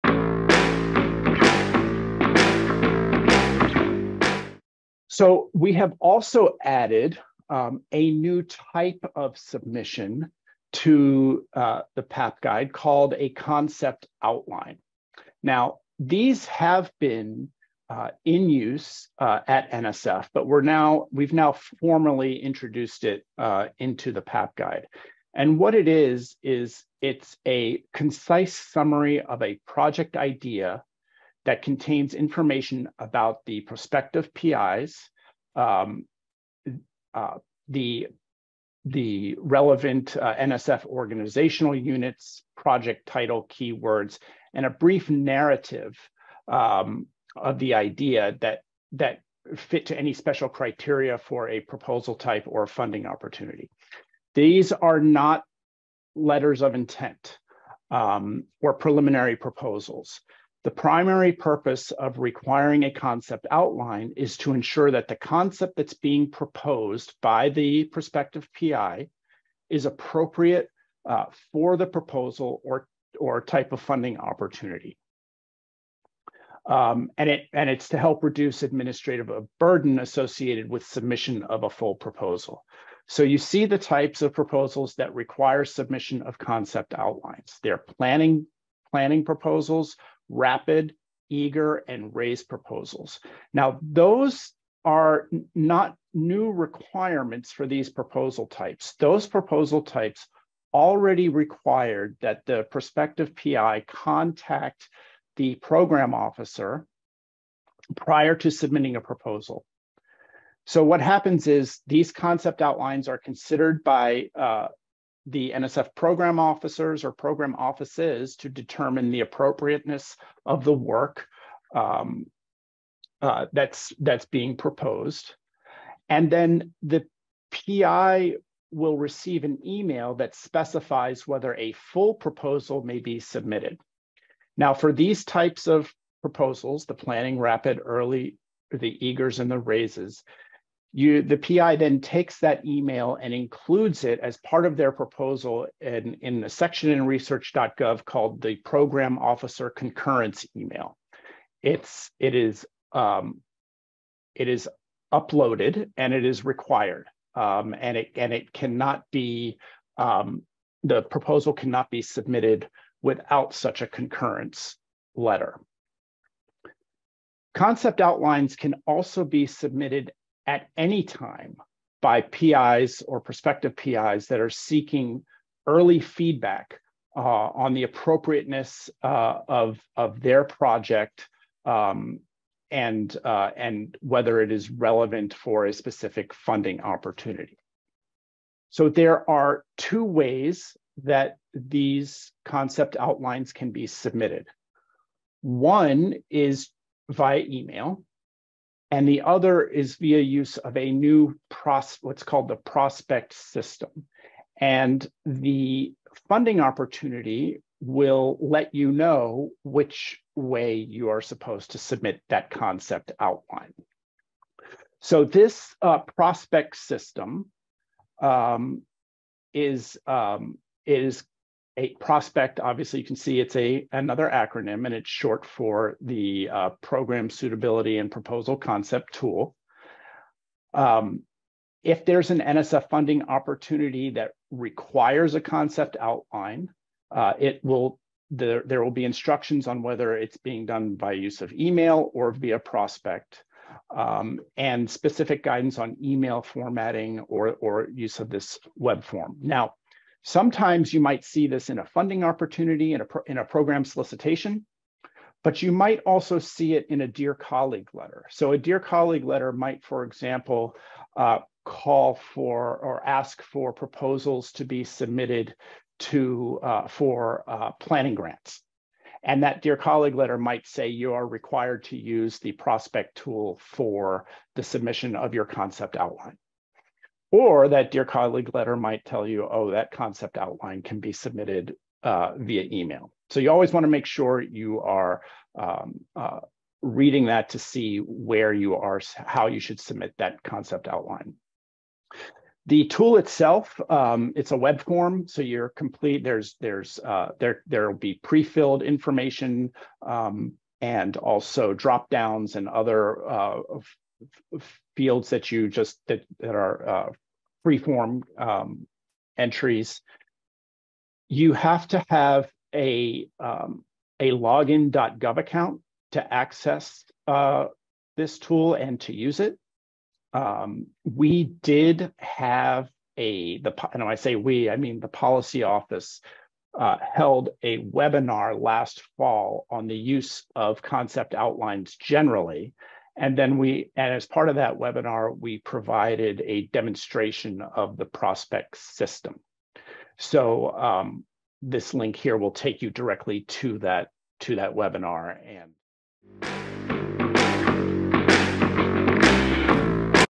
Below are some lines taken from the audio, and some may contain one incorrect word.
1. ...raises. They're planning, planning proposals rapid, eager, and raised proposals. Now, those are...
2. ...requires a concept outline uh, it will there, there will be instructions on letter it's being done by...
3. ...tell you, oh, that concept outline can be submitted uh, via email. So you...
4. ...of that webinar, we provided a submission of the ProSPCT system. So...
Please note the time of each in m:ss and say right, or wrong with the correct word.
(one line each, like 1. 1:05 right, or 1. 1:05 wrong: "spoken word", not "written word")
1. 1:26 wrong: "outlines", not "raises"
2. 3:54 wrong: "whether", not "letter"
3. 4:39 right
4. 5:34 wrong: "demonstration", not "submission".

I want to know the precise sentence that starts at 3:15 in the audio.
One is via email, and the other is via use of a new pros, what's called the ProSPCT system.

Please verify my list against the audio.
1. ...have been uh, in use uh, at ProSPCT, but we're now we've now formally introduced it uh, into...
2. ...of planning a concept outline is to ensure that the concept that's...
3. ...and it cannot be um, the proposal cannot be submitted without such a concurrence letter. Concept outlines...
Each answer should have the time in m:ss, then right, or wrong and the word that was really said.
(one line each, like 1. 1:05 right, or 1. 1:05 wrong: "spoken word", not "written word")
1. 0:16 wrong: "NSF", not "ProSPCT"
2. 1:01 wrong: "requiring", not "planning"
3. 2:38 right.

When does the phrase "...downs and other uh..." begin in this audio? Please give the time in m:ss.
5:02.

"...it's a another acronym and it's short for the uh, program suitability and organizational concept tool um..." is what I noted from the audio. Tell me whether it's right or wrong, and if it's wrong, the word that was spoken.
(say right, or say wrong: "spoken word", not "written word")
wrong: "proposal", not "organizational".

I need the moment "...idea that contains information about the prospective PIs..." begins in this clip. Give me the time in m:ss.
0:30.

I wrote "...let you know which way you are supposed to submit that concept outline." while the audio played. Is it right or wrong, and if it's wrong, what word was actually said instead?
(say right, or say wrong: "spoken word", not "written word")
right.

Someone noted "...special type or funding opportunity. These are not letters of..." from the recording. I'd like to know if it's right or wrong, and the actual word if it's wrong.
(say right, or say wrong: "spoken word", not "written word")
wrong: "proposal", not "special".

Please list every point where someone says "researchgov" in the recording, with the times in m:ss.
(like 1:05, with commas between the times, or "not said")
2:27.